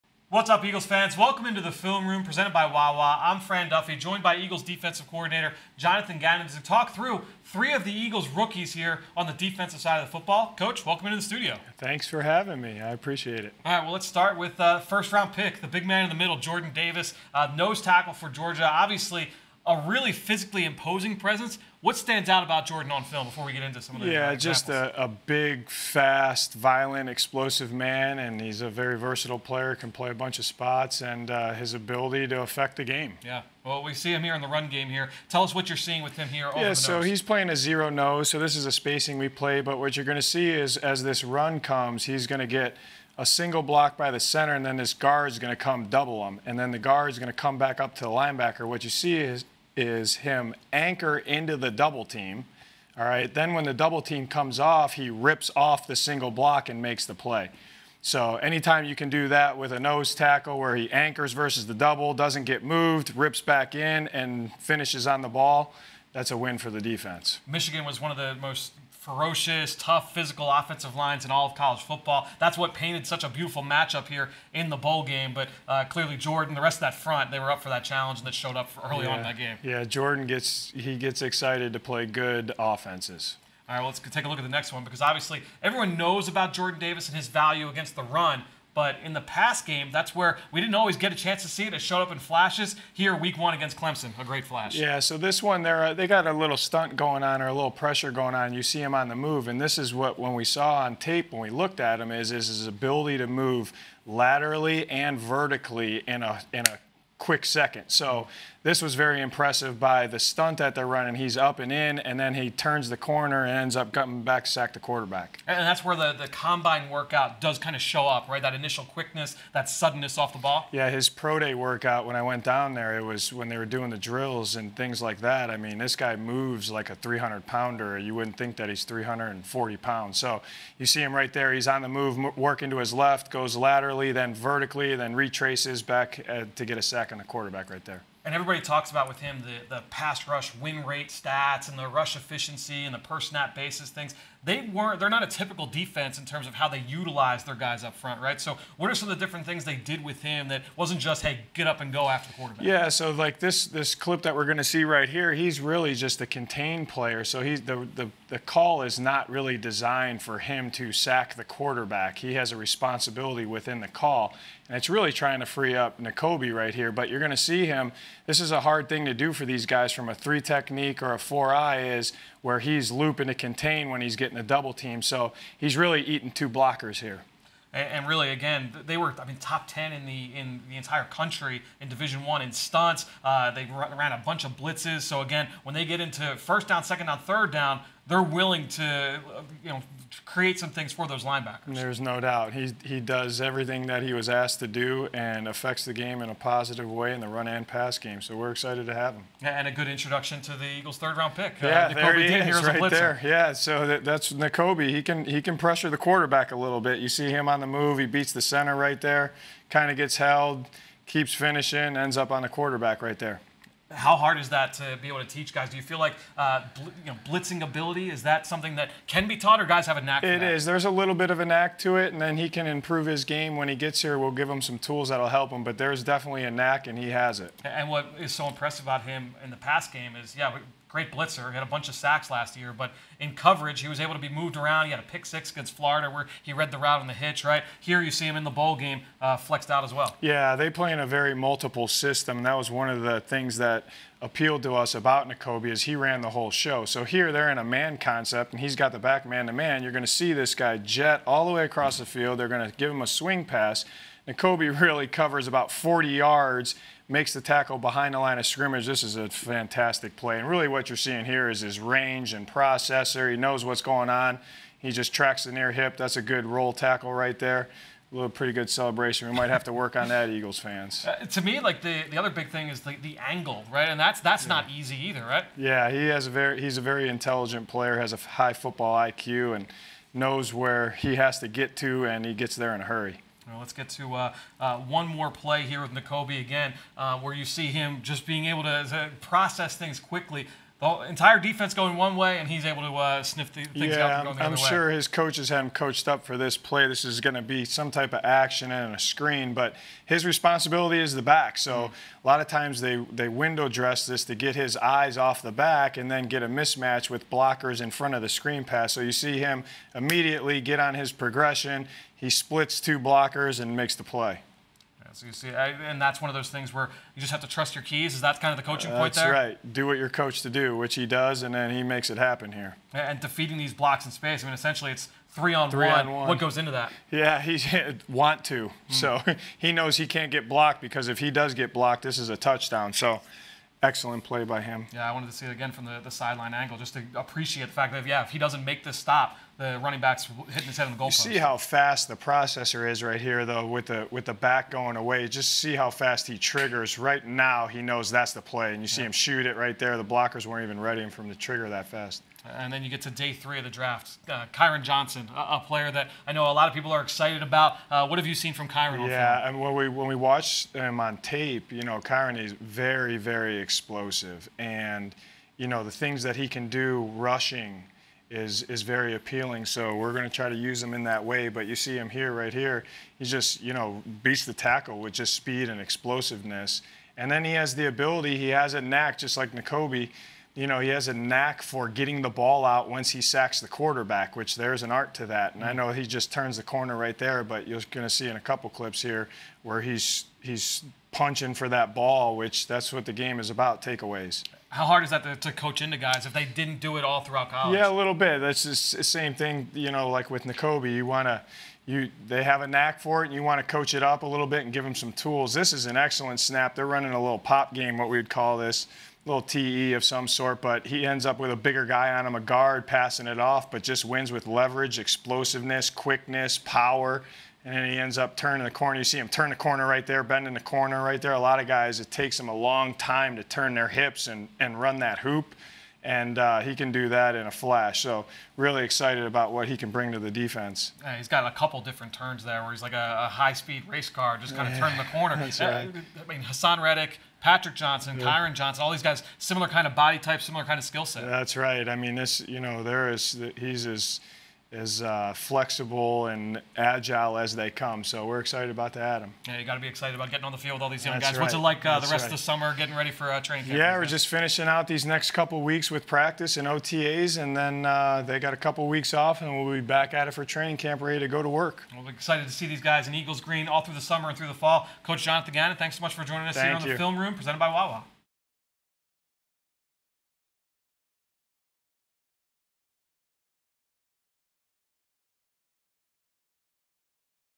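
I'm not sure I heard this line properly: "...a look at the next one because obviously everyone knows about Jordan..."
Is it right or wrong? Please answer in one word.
right.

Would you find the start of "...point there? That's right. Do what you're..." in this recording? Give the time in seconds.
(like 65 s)
318 s.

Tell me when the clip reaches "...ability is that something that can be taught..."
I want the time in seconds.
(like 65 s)
217 s.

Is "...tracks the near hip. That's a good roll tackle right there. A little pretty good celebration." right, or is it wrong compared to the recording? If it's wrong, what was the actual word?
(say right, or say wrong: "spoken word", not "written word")
right.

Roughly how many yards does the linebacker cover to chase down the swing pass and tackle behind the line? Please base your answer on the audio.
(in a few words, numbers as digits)
40 yards.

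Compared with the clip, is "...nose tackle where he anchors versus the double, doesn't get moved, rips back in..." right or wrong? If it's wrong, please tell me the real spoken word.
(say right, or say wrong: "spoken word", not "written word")
right.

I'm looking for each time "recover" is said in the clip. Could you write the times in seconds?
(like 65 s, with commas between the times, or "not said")
not said.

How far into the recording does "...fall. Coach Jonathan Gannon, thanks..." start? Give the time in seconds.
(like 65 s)
464 s.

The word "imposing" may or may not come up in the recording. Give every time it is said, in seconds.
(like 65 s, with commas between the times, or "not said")
20 s.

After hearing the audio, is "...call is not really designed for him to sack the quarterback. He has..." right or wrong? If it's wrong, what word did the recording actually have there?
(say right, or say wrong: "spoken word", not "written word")
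right.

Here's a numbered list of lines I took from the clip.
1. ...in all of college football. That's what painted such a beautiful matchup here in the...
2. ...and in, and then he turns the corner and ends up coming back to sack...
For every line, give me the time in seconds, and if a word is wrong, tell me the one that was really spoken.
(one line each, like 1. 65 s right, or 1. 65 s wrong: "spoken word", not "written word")
1. 71 s right
2. 111 s right.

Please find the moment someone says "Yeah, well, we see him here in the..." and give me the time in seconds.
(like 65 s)
33 s.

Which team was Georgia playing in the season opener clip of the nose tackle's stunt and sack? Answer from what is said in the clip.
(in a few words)
Clemson.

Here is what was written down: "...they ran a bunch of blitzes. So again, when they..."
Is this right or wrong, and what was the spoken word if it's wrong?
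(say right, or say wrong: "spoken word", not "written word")
right.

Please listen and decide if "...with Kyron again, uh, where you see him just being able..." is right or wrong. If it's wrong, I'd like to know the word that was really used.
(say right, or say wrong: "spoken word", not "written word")
wrong: "Nakobe", not "Kyron".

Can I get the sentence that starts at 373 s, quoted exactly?
He just, you know, beats the tackle with just speed and explosiveness.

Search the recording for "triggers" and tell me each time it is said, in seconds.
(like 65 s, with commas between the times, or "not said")
346 s, 351 s.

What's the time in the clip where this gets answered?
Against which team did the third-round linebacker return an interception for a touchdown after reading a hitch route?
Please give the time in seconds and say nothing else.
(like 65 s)
235 s.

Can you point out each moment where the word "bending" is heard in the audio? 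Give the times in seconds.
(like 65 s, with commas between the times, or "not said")
420 s.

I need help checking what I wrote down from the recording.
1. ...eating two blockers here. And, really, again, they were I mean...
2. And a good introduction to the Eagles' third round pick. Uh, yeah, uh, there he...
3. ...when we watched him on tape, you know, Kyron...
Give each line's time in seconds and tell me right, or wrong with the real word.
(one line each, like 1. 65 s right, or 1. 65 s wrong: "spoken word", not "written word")
1. 176 s right
2. 199 s right
3. 359 s right.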